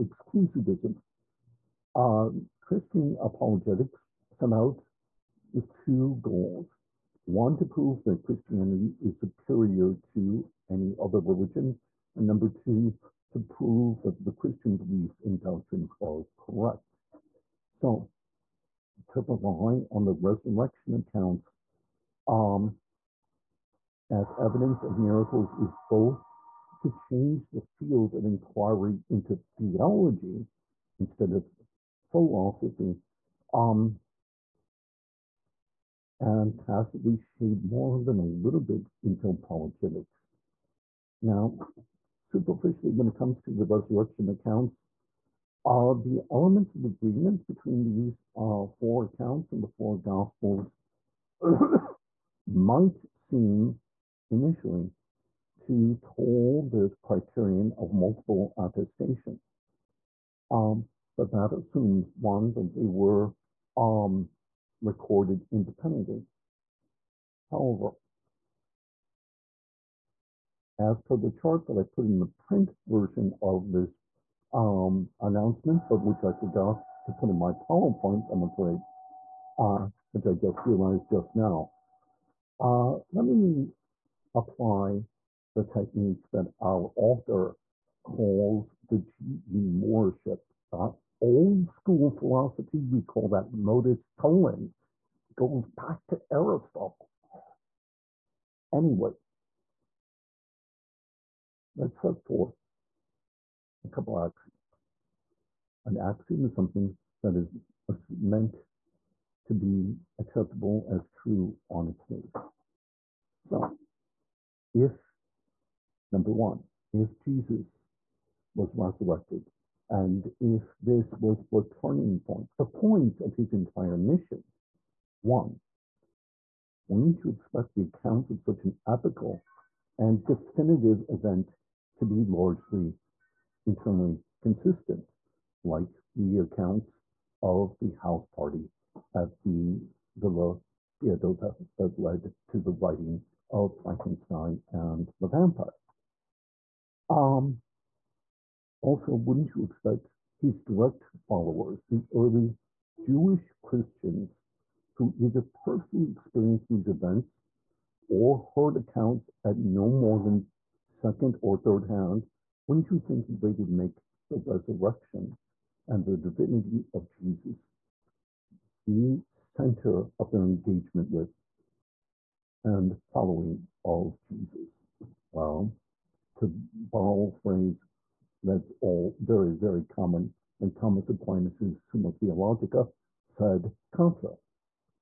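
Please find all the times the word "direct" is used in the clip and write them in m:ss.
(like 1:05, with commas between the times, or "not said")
2:30.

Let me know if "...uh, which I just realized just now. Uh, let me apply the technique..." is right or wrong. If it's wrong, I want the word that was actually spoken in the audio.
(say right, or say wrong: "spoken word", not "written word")
right.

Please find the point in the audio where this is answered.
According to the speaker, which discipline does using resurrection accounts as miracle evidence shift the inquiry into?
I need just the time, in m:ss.
0:29.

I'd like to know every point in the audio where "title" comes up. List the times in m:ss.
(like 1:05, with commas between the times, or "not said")
not said.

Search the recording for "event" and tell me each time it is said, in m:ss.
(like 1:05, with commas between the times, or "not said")
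2:11, 2:36.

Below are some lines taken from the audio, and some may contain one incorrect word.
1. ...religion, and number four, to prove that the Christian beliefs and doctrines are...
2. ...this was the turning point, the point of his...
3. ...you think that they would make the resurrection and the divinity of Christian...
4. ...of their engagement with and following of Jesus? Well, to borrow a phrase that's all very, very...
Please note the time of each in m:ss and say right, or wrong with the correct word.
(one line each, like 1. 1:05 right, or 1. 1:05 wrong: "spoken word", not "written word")
1. 0:11 wrong: "two", not "four"
2. 2:00 right
3. 2:42 wrong: "Jesus", not "Christian"
4. 2:50 right.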